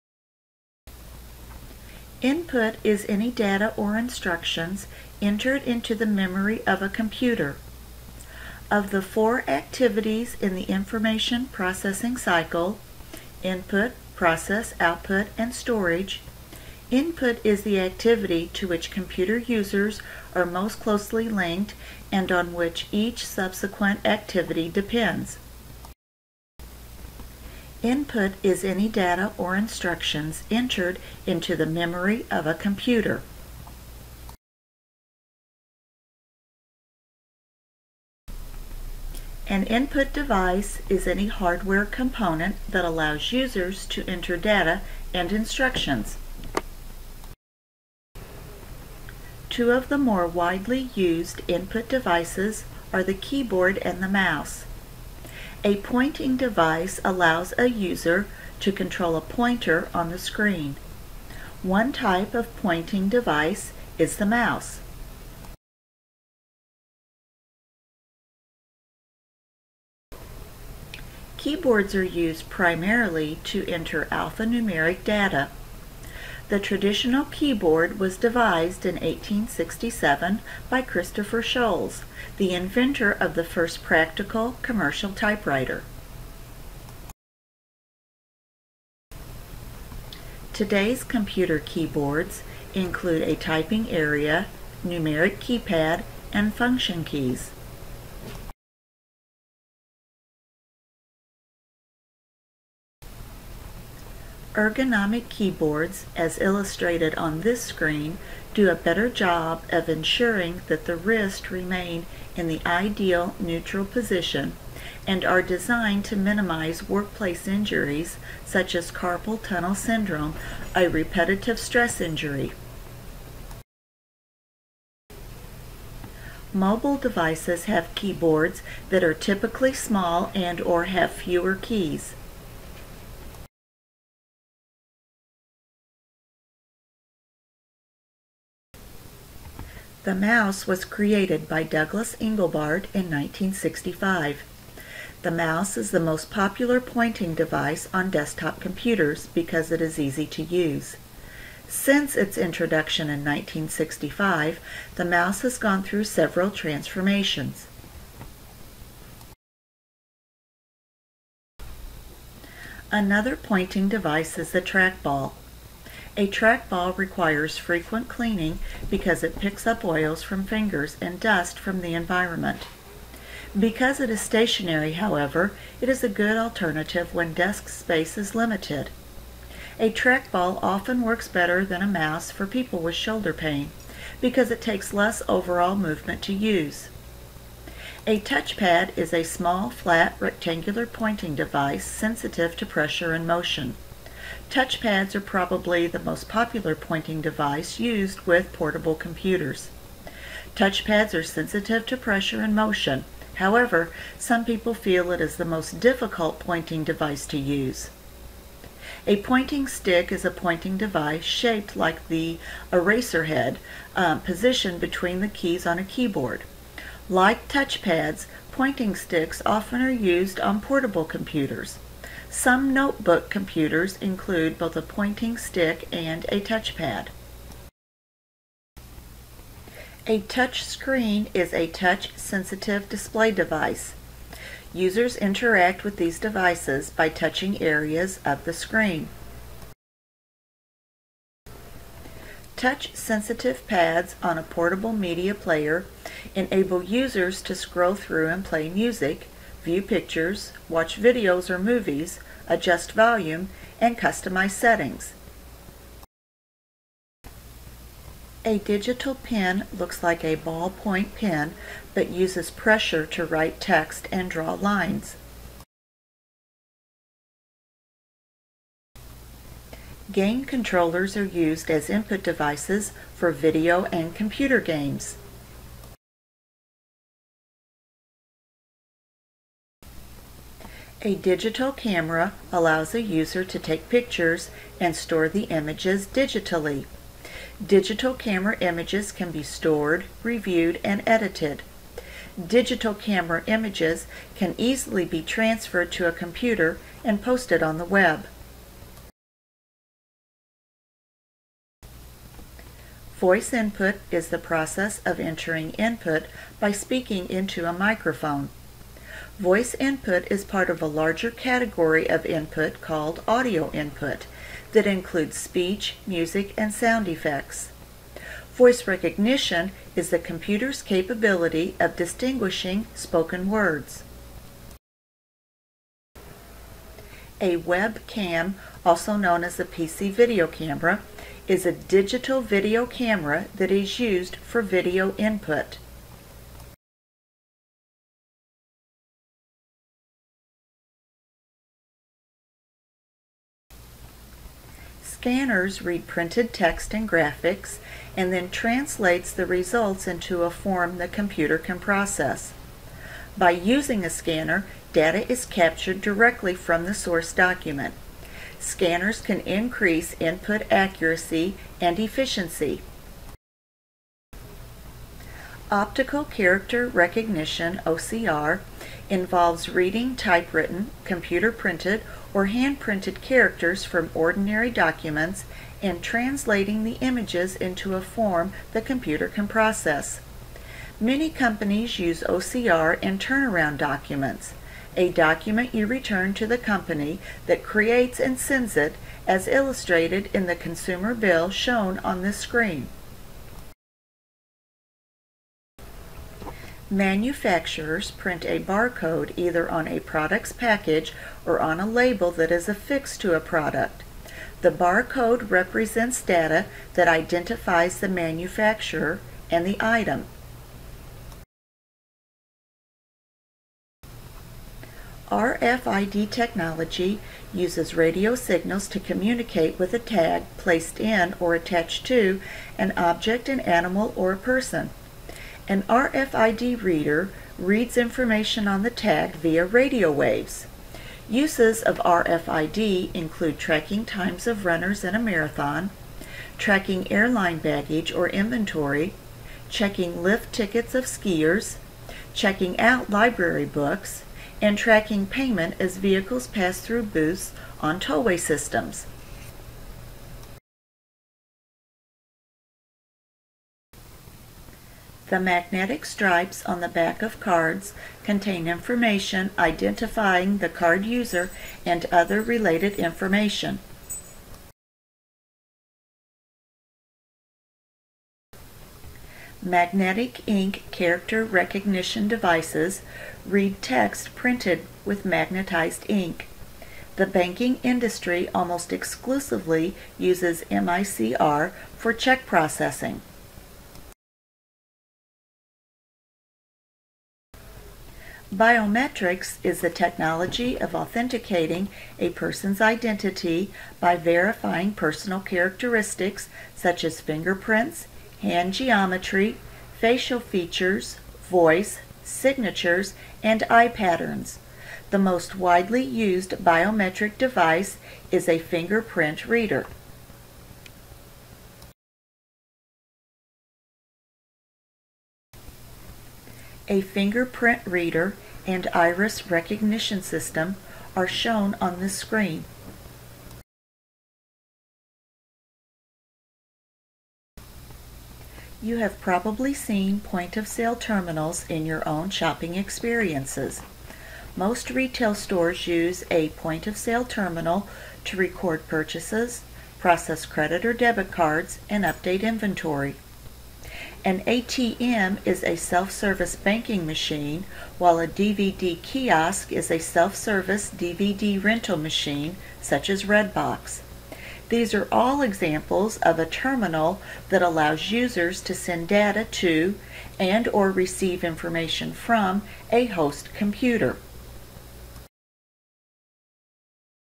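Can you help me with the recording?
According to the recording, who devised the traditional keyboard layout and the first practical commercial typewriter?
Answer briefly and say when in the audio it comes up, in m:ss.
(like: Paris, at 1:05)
Christopher Sholes, at 1:20.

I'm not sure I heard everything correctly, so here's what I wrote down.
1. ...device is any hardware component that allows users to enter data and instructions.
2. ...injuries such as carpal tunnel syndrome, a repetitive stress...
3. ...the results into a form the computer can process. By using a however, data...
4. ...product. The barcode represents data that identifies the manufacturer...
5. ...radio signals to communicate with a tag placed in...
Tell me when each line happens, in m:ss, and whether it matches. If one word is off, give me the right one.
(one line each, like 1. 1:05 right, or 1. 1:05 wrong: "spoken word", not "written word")
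1. 0:40 right
2. 1:57 right
3. 5:49 wrong: "scanner", not "however"
4. 6:43 right
5. 6:57 right.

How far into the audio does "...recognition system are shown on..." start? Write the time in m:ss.
8:39.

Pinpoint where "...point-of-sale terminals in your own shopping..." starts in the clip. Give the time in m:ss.
8:50.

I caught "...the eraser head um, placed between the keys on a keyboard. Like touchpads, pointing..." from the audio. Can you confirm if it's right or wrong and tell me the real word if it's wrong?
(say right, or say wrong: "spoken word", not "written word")
wrong: "positioned", not "placed".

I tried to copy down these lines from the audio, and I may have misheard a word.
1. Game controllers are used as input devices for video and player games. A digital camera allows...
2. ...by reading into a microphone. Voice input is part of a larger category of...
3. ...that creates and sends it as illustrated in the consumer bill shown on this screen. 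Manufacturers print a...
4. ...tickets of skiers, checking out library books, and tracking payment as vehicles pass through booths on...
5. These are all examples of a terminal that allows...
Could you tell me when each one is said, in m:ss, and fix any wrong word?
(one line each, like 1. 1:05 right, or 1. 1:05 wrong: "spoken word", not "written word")
1. 4:30 wrong: "computer", not "player"
2. 5:06 wrong: "speaking", not "reading"
3. 6:27 right
4. 7:20 right
5. 9:14 right.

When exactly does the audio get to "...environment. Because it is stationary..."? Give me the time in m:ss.
2:51.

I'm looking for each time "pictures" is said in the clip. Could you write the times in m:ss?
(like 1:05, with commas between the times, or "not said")
4:09, 4:43.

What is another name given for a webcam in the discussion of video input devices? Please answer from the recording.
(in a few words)
PC video camera.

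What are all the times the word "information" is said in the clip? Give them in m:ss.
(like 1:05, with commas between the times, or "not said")
0:10, 7:07, 7:38, 7:42, 9:21.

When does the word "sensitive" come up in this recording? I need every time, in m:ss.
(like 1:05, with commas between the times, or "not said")
3:11, 3:21, 3:51, 4:02.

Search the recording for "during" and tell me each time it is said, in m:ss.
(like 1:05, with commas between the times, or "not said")
not said.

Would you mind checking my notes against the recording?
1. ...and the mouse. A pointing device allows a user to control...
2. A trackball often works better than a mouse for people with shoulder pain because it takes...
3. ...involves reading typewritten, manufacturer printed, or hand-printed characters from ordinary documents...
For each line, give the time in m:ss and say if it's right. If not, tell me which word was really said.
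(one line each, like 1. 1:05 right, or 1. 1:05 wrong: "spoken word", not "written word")
1. 0:53 right
2. 2:59 right
3. 6:09 wrong: "computer", not "manufacturer".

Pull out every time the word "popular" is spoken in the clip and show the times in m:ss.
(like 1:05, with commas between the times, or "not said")
2:26, 3:16.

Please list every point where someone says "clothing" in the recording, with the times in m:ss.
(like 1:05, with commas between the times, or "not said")
not said.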